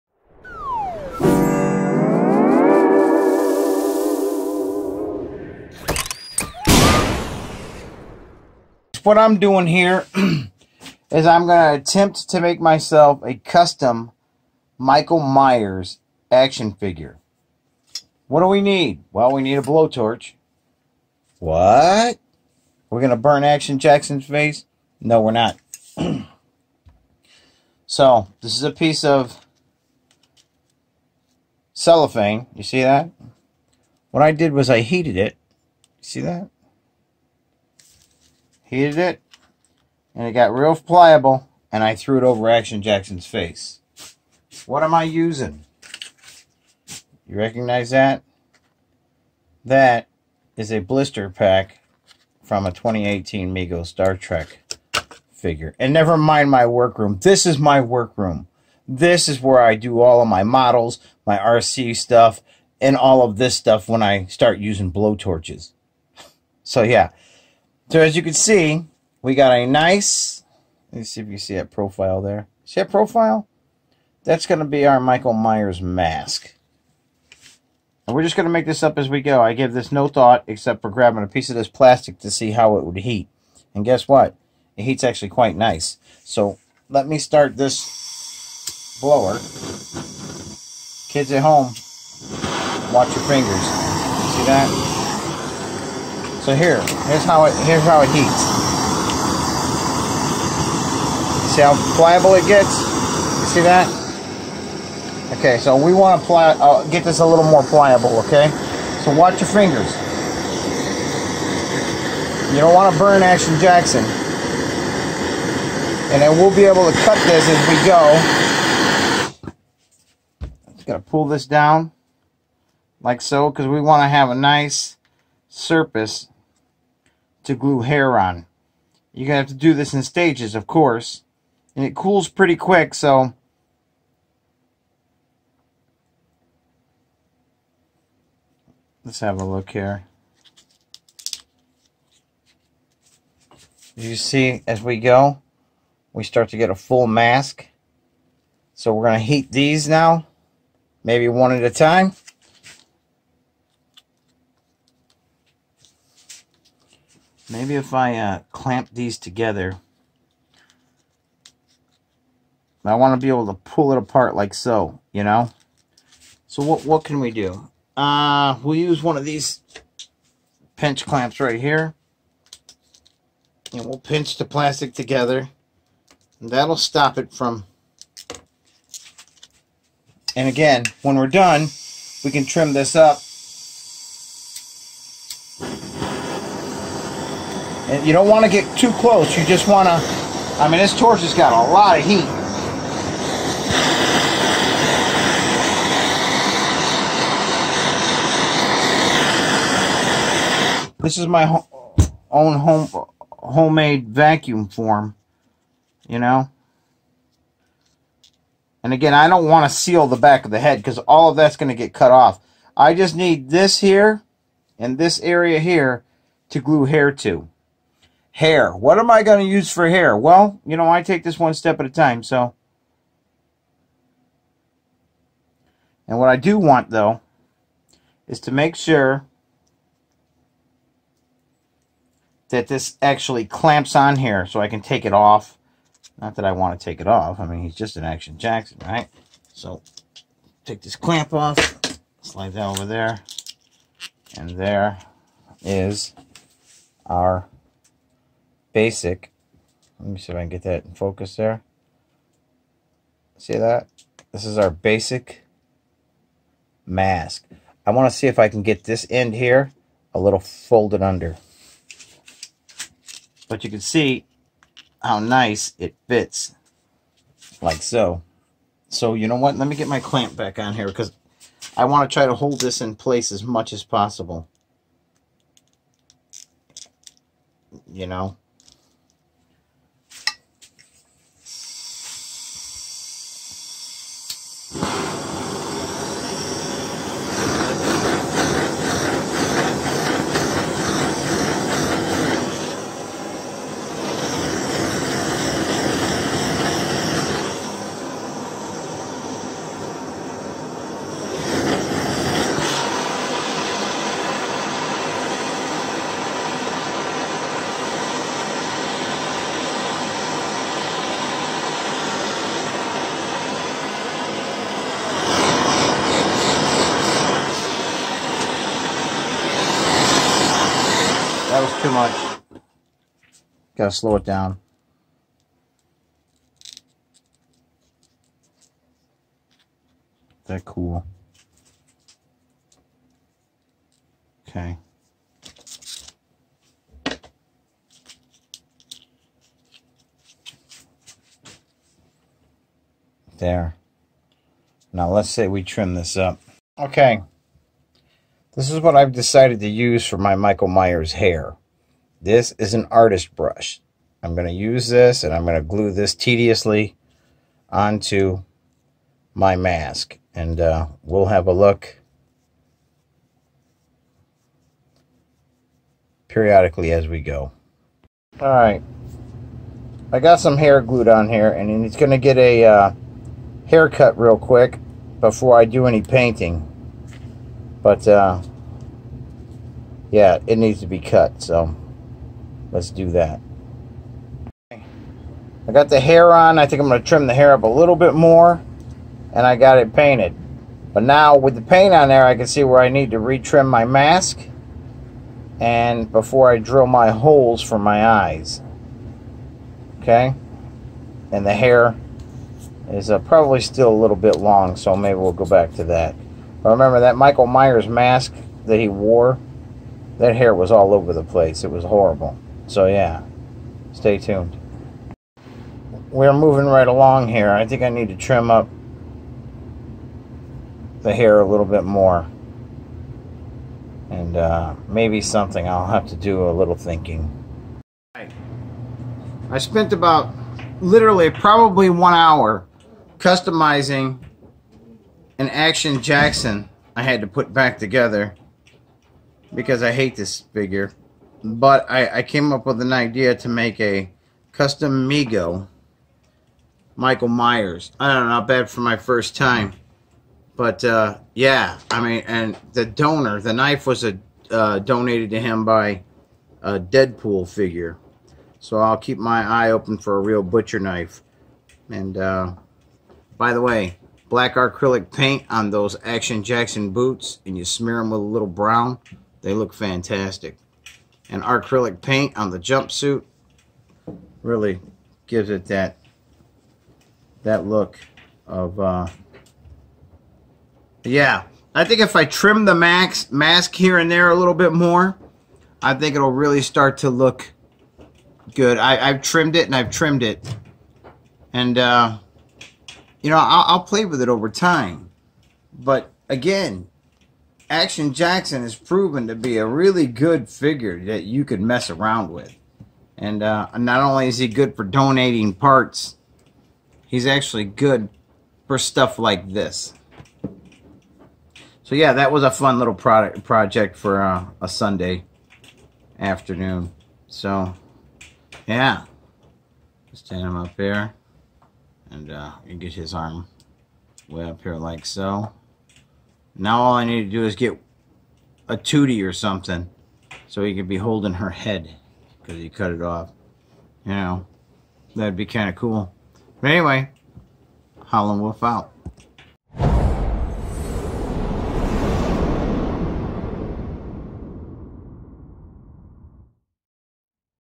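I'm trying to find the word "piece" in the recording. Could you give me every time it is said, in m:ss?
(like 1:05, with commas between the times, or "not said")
0:28, 1:21.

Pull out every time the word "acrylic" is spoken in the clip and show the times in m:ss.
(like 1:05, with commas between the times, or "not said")
7:44, 7:51.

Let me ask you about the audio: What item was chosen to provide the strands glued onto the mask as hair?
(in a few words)
Artist brush.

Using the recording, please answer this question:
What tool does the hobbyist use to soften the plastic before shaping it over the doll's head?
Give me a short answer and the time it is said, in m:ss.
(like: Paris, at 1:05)
Blowtorch, at 0:19.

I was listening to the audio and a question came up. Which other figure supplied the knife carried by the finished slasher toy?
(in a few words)
Deadpool.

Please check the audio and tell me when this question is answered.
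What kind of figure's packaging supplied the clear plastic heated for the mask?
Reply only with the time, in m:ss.
0:52.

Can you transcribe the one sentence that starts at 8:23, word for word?
And uh, not only is he good for donating parts, he's actually good for stuff like this.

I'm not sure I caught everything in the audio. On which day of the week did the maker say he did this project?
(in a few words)
Sunday.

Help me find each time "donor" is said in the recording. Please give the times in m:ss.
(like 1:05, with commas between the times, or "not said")
7:32.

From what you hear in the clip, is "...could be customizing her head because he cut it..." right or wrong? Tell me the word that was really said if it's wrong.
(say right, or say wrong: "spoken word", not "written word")
wrong: "holding", not "customizing".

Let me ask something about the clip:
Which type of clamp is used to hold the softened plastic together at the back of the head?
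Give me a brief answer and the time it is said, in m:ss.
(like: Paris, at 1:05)
Pinch clamps, at 2:50.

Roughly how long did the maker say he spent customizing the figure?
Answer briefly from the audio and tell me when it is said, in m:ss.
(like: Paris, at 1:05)
1 hour, at 7:11.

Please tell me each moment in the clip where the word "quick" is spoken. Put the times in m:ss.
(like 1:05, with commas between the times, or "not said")
2:12, 6:14.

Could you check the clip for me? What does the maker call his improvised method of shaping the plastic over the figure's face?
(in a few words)
Homemade vacuum form.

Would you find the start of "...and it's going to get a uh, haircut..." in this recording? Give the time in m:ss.
6:11.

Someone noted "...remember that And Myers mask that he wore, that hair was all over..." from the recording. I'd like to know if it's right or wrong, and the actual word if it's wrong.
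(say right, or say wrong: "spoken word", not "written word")
wrong: "Michael", not "And".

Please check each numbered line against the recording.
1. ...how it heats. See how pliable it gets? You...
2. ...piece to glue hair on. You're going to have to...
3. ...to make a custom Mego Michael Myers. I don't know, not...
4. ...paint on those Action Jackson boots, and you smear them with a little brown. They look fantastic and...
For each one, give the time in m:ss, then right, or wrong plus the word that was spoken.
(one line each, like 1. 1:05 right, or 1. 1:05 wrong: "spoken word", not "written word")
1. 1:37 right
2. 2:05 wrong: "surface", not "piece"
3. 7:23 right
4. 7:45 right.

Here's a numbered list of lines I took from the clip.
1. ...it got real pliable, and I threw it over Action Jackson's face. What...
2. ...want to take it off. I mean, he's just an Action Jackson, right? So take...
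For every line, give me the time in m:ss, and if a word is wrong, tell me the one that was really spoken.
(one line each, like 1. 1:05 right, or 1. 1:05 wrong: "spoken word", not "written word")
1. 0:40 right
2. 3:56 right.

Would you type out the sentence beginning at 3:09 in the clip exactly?
You just want to, I mean, this torch has got a lot of heat.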